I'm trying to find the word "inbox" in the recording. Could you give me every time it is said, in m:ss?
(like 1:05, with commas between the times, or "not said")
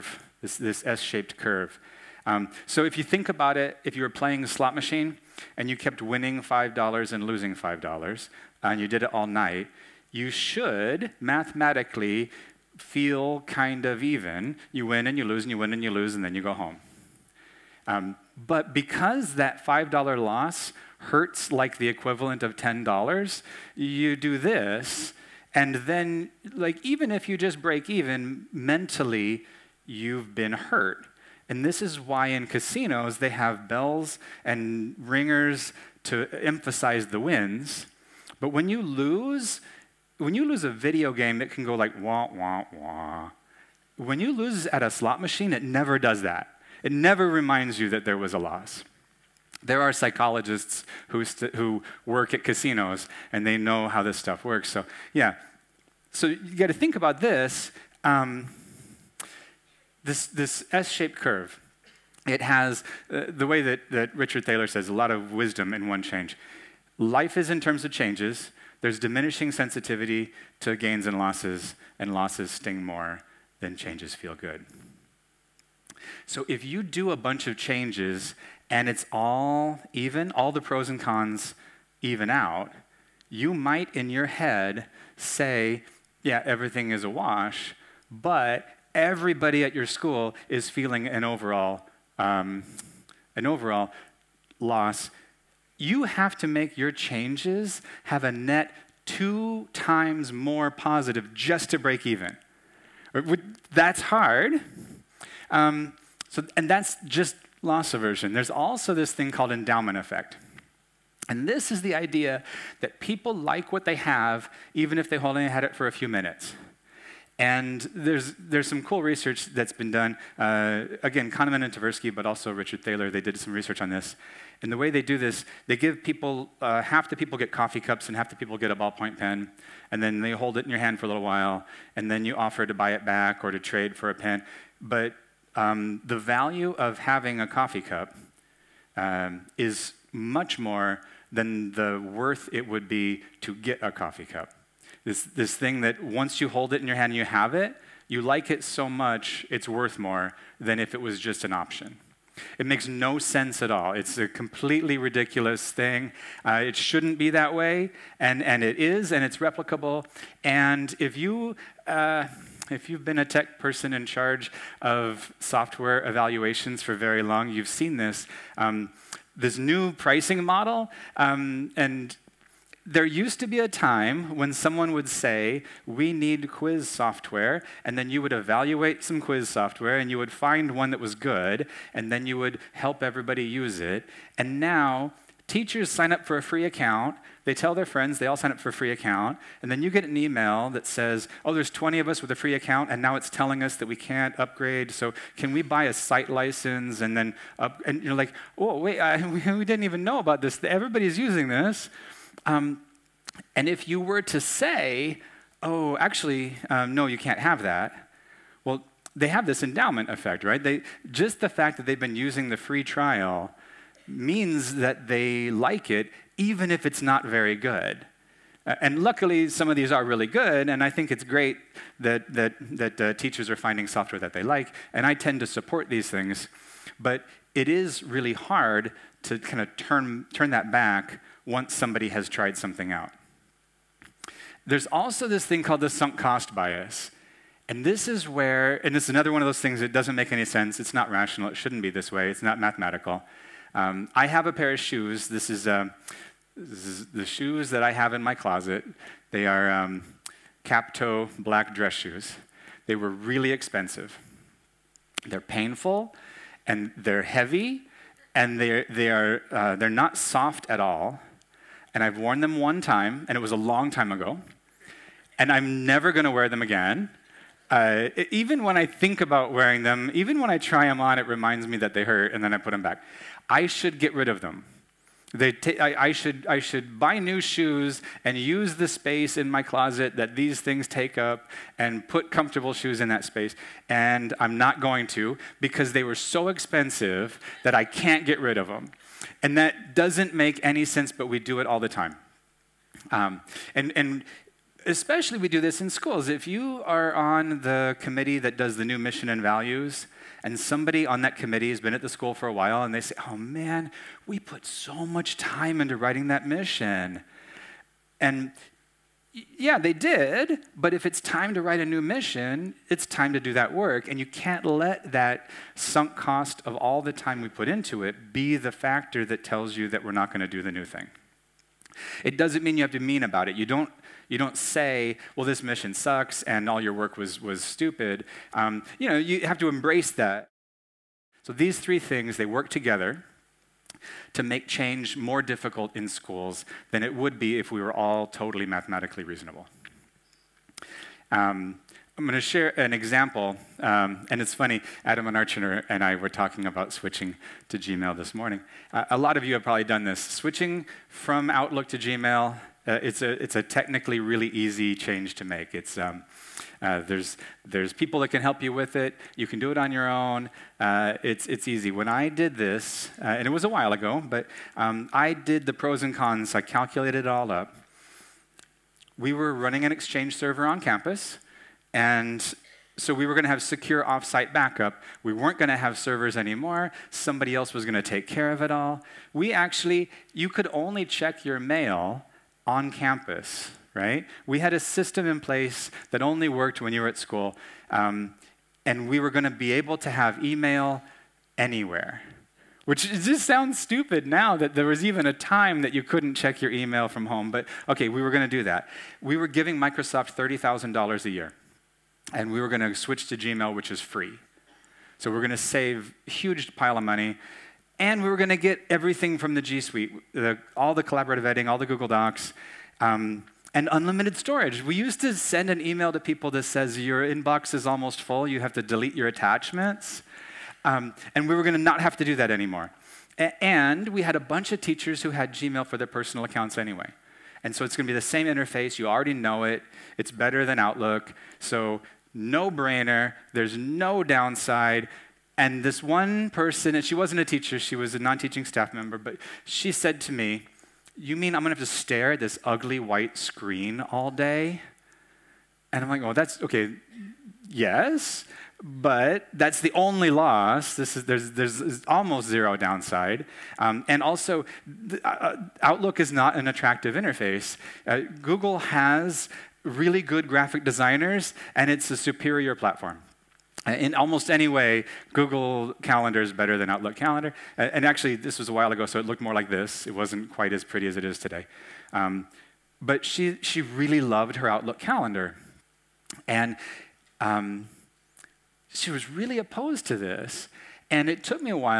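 6:57.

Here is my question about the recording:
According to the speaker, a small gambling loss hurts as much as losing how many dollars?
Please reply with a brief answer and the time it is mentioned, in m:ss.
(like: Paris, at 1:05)
$10, at 0:22.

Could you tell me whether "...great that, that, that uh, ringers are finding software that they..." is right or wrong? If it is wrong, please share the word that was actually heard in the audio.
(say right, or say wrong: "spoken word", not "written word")
wrong: "teachers", not "ringers".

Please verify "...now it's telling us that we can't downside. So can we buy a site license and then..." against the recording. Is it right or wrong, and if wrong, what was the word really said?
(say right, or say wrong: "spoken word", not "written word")
wrong: "upgrade", not "downside".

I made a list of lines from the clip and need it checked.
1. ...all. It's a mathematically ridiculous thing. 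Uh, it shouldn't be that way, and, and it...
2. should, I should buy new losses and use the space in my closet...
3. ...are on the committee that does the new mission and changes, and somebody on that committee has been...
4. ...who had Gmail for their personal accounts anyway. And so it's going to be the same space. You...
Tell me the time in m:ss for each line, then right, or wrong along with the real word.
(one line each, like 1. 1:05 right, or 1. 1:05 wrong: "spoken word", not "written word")
1. 2:33 wrong: "completely", not "mathematically"
2. 4:36 wrong: "shoes", not "losses"
3. 4:56 wrong: "values", not "changes"
4. 7:05 wrong: "interface", not "space".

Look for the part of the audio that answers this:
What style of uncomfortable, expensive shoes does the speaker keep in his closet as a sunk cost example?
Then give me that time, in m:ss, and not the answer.
4:10.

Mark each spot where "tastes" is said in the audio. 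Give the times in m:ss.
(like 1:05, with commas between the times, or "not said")
not said.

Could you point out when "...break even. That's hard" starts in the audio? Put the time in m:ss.
1:41.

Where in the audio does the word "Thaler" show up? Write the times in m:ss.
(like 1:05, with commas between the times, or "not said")
1:04, 2:02.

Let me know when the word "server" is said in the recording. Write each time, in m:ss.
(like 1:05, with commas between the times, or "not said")
6:10, 6:15.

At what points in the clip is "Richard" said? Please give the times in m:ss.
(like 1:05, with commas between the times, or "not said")
1:04, 2:02.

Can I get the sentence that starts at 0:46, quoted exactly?
It never reminds you that there was a loss.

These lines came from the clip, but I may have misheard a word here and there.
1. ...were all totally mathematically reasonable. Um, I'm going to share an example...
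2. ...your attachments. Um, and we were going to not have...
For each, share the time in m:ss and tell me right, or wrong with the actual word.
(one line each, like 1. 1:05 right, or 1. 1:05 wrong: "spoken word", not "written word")
1. 5:37 right
2. 6:59 right.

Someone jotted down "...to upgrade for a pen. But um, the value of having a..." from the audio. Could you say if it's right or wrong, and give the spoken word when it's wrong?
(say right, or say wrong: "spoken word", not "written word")
wrong: "trade", not "upgrade".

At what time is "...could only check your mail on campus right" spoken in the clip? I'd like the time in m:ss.
6:20.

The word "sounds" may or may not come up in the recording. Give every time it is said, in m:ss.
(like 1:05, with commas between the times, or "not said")
6:33.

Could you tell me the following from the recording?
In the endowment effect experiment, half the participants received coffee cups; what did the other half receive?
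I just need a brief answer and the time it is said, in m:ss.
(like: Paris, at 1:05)
a ballpoint pen, at 2:08.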